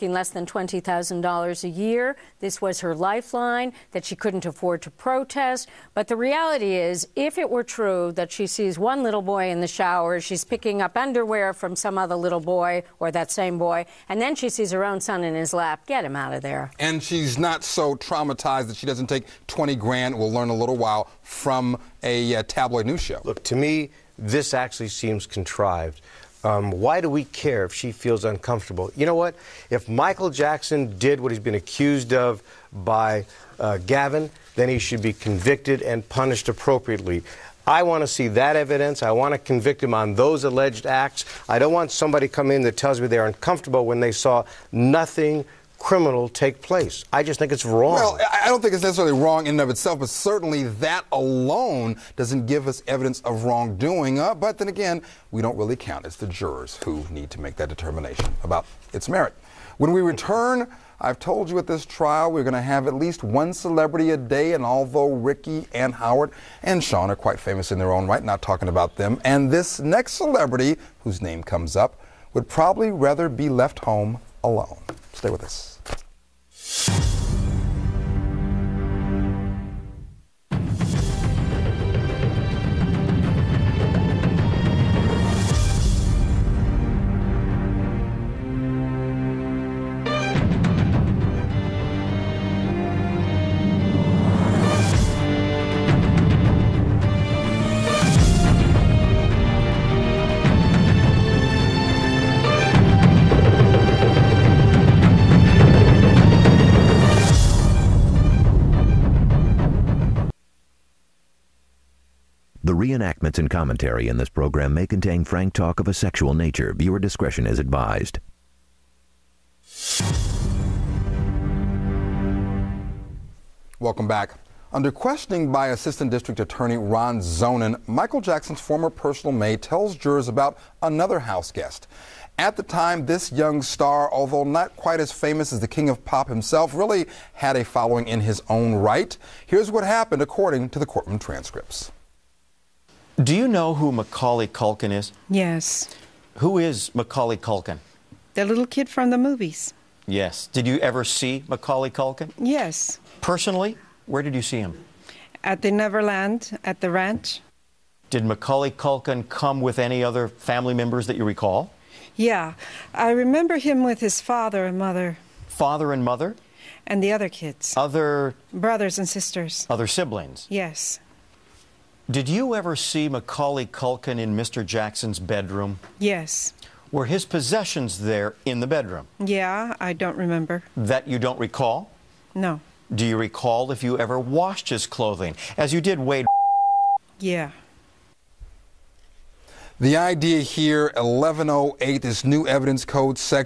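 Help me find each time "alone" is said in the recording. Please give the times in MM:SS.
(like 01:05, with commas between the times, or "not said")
00:51, 01:14.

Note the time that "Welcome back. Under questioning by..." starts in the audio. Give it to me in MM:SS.
02:03.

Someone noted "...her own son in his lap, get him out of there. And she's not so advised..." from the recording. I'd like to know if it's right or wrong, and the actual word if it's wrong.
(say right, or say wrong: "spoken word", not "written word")
wrong: "traumatized", not "advised".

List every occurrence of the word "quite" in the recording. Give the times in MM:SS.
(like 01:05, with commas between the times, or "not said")
01:07, 02:14.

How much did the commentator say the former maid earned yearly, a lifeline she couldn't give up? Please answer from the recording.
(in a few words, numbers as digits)
less than $20,000.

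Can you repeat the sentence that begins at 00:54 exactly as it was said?
Uh, but then again, we don't really count.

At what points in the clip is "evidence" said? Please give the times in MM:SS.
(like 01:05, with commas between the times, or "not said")
00:38, 00:52, 03:12.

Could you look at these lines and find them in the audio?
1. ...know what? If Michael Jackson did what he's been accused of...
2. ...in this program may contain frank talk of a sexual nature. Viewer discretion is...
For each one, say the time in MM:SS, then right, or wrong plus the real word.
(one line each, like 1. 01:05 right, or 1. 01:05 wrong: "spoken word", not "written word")
1. 00:29 right
2. 01:54 right.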